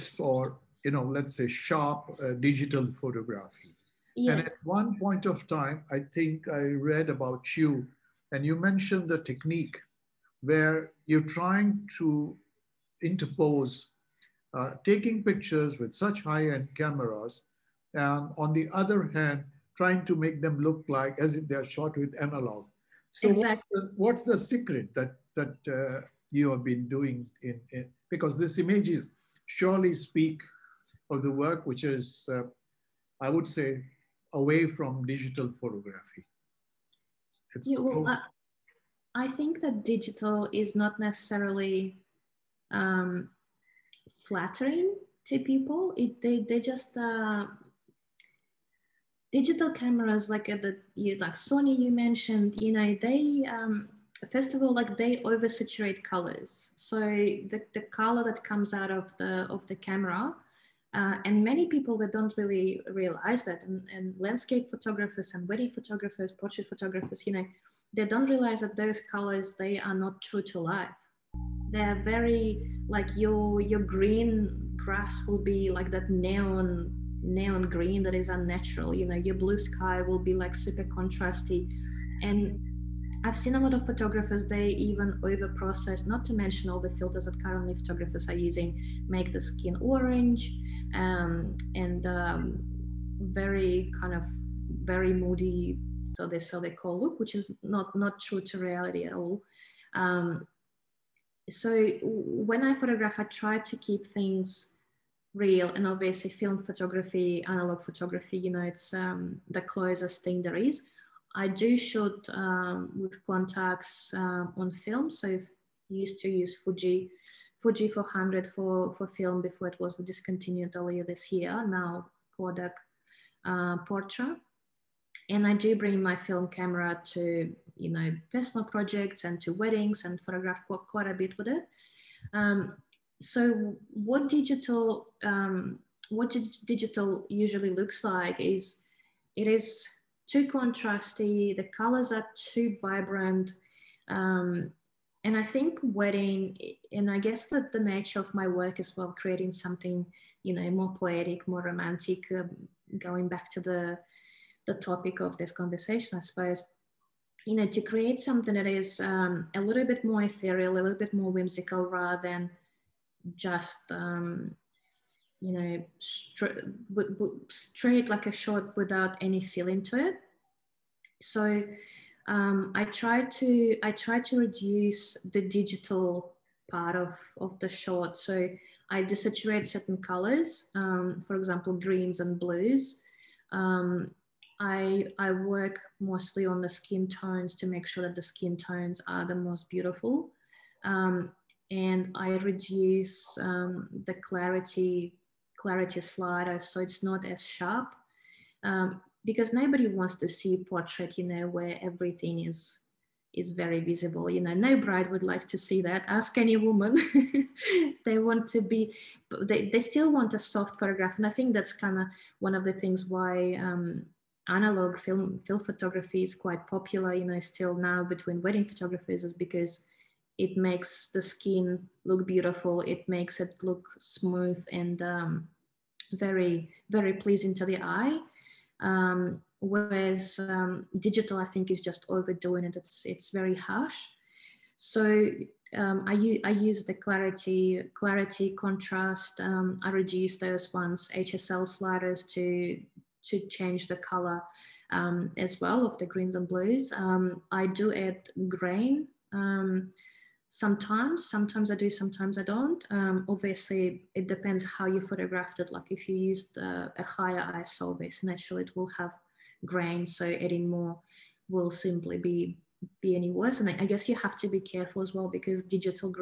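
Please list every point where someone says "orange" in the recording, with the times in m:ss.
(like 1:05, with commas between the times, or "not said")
1:29.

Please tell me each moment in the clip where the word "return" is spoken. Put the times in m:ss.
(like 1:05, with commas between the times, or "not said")
not said.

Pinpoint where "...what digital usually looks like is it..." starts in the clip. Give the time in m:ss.
2:16.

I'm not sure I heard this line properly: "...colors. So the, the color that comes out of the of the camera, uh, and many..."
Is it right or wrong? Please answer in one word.
right.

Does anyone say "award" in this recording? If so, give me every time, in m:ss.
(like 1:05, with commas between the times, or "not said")
not said.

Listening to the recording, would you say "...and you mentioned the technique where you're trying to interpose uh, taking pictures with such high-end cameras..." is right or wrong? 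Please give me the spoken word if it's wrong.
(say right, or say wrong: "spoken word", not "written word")
right.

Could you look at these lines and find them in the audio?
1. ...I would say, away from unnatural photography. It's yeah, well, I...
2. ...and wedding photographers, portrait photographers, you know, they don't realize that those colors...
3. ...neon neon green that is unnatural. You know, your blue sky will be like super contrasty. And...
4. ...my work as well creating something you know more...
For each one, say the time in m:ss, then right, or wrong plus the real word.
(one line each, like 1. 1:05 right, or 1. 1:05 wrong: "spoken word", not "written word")
1. 0:33 wrong: "digital", not "unnatural"
2. 1:05 right
3. 1:16 right
4. 2:28 right.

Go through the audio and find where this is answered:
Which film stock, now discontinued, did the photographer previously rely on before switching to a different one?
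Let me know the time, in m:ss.
1:57.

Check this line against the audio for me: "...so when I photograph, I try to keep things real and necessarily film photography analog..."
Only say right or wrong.
wrong.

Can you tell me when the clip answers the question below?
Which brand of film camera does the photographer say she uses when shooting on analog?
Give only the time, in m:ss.
1:53.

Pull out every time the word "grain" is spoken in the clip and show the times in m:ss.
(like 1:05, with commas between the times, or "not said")
4:08, 4:19.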